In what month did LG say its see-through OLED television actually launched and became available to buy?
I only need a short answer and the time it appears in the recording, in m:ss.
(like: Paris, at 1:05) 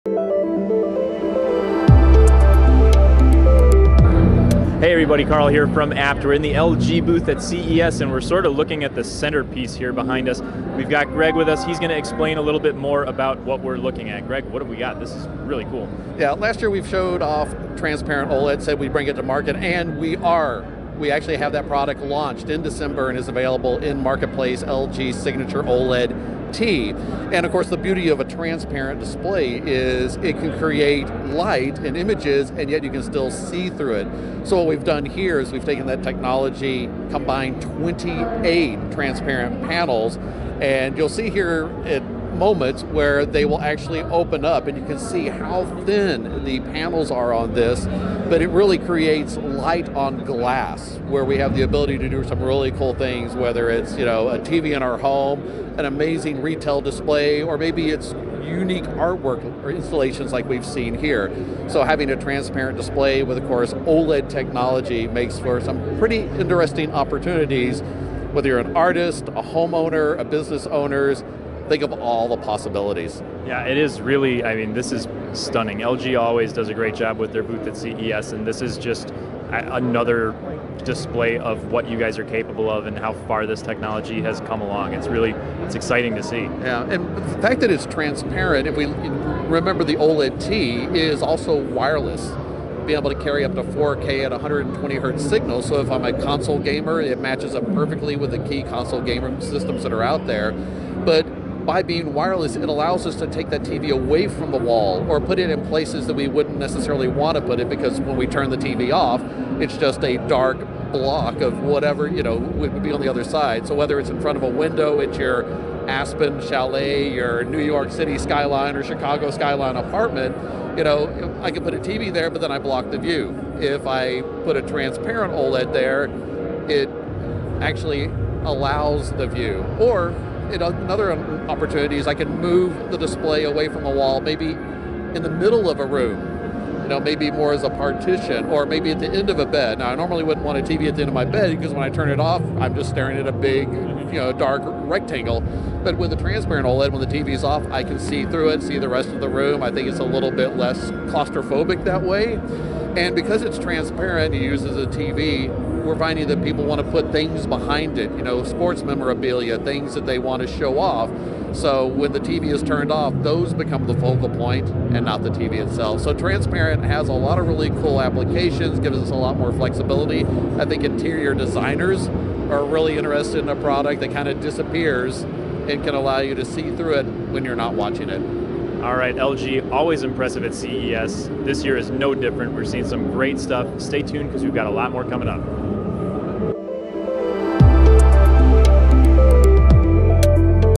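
December, at 0:22.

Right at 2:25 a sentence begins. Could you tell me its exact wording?
But with a transparent OLED, when the TV's off, I can see through it, see the rest of the room.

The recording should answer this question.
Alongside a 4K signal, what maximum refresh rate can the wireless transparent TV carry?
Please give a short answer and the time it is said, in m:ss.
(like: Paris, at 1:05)
120 hertz, at 1:34.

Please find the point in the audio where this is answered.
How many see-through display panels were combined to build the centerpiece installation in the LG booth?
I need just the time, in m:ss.
0:37.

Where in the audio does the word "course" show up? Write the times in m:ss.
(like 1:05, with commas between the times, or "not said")
0:27, 1:03.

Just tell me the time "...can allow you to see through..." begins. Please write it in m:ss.
2:55.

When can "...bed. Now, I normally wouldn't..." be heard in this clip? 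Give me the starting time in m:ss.
2:19.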